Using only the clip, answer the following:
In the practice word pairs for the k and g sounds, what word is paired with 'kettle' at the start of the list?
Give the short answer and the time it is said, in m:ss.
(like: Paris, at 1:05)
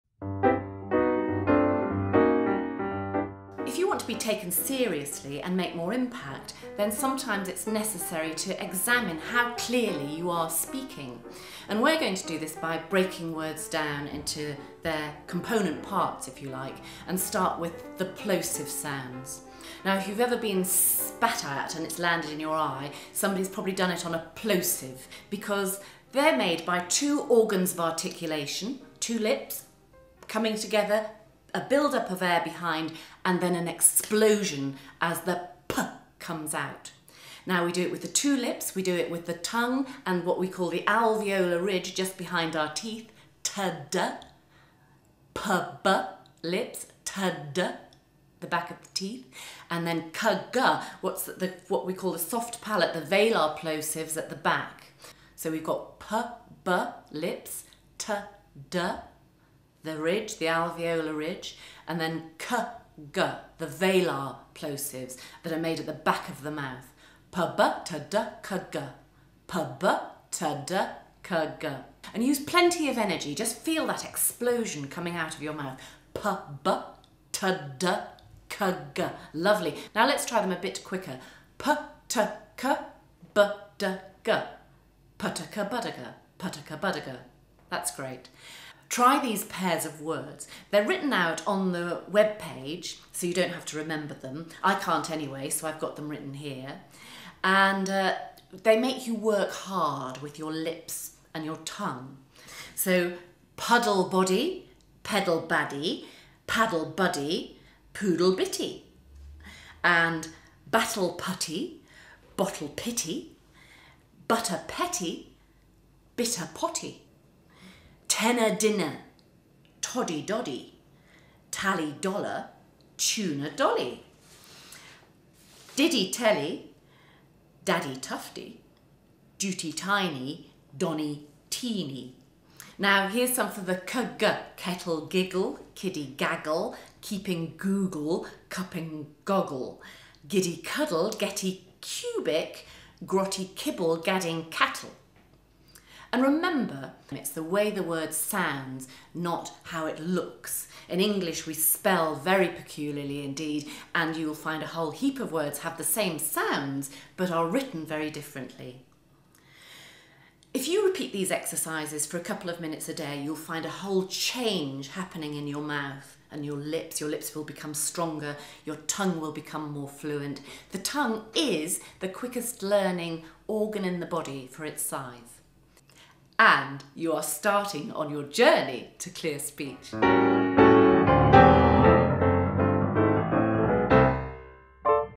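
giggle, at 2:15.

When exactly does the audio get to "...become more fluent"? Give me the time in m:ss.
2:49.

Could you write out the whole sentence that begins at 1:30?
They're written out on the web page, so you don't have to remember them.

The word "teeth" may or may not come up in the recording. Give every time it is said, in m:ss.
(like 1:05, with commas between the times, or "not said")
0:42, 0:48.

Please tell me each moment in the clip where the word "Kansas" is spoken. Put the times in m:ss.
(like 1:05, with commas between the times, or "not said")
not said.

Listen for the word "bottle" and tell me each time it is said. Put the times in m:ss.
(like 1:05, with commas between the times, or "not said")
1:52.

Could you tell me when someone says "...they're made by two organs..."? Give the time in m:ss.
0:26.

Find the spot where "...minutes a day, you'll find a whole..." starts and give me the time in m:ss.
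2:42.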